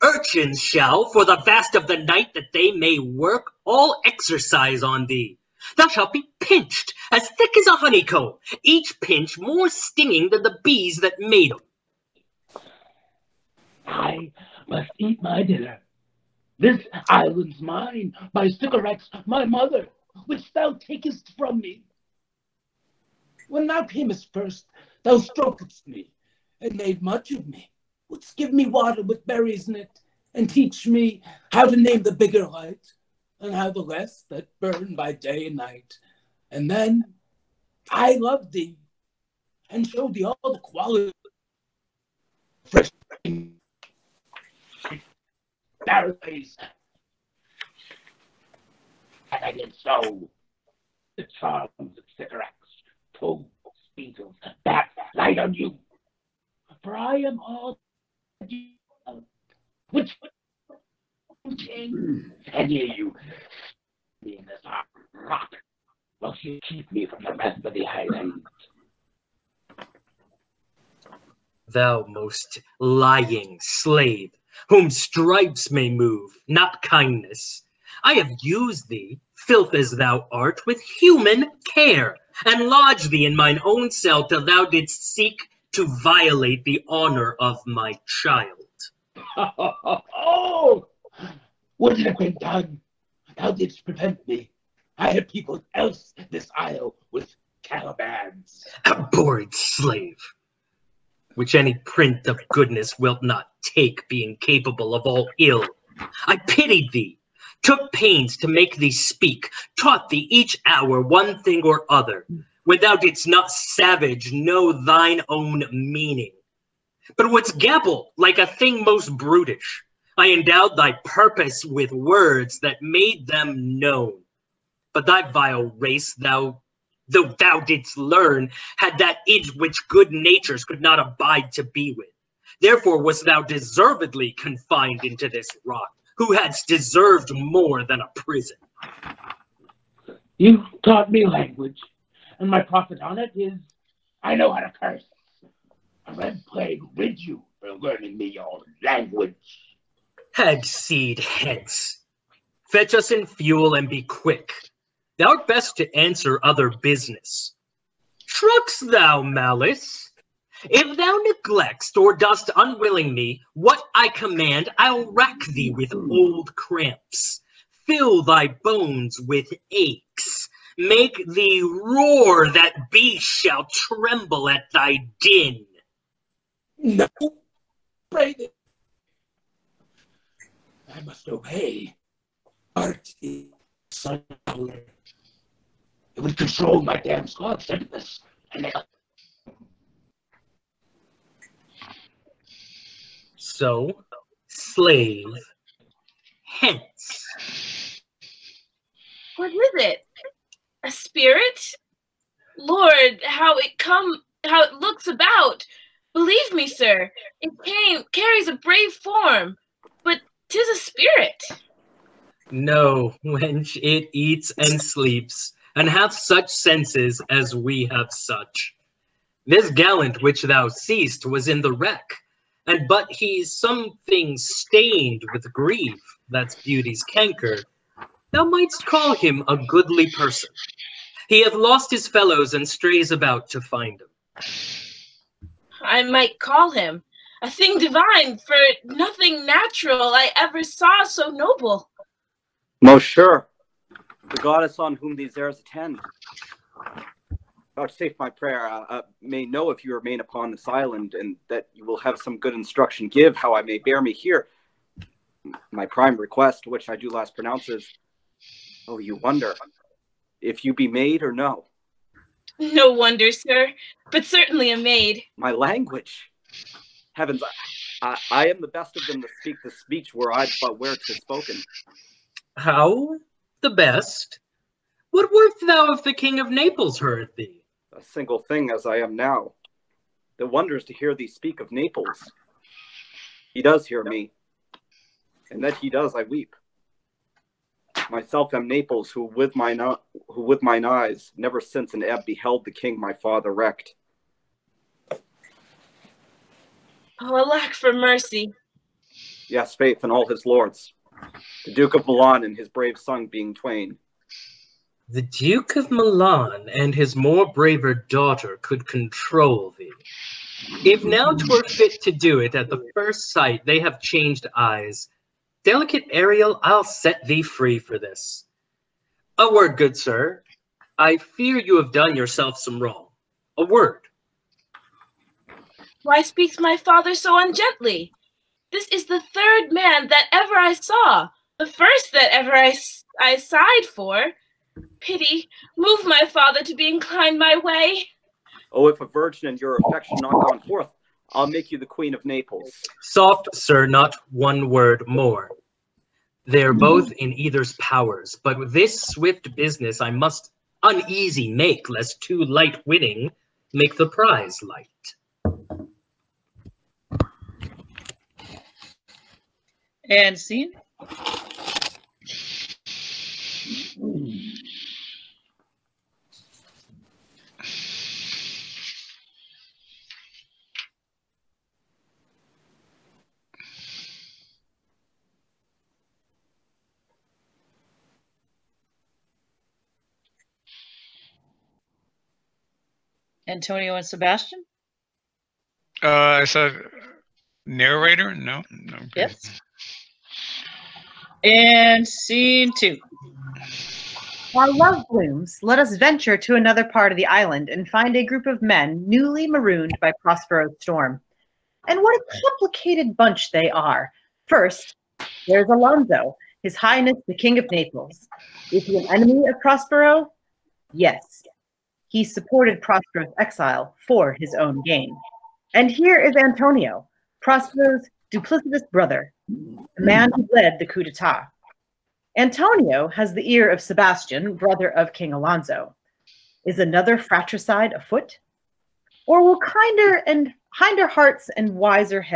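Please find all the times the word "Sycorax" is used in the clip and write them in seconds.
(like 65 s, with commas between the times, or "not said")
18 s, 52 s.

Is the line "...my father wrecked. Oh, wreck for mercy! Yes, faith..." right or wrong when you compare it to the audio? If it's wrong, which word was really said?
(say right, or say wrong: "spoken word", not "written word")
wrong: "alack", not "wreck".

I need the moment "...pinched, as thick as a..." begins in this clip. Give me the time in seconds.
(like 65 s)
6 s.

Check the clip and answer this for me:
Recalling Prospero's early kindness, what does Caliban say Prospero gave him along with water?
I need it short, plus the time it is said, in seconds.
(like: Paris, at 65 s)
berries, at 29 s.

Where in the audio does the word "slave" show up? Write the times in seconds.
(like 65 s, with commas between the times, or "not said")
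73 s, 99 s, 194 s.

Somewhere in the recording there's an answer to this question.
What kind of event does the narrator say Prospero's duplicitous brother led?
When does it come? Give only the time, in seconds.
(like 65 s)
420 s.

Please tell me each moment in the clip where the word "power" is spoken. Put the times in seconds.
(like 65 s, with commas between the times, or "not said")
184 s, 347 s.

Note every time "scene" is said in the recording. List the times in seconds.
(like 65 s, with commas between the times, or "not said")
360 s, 392 s.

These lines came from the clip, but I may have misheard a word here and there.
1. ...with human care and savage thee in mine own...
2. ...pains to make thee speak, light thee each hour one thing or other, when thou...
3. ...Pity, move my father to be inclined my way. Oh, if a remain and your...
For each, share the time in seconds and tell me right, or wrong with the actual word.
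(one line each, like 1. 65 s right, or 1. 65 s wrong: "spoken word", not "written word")
1. 80 s wrong: "lodge", not "savage"
2. 107 s wrong: "taught", not "light"
3. 335 s wrong: "virgin", not "remain".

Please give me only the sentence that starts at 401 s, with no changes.
And what a complicated bunch they are.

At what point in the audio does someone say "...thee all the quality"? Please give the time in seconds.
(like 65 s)
40 s.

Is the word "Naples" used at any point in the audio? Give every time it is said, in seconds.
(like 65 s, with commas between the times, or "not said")
276 s, 281 s, 288 s, 342 s, 407 s.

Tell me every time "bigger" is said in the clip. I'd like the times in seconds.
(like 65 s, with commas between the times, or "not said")
32 s.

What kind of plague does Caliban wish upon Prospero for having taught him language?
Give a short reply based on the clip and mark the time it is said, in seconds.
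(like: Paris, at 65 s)
A red plague, at 146 s.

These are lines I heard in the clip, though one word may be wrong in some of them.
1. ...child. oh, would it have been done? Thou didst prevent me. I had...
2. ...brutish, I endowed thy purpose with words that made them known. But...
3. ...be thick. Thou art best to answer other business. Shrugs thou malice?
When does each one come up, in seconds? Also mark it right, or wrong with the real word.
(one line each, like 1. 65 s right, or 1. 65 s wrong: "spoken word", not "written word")
1. 88 s right
2. 119 s right
3. 153 s wrong: "quick", not "thick".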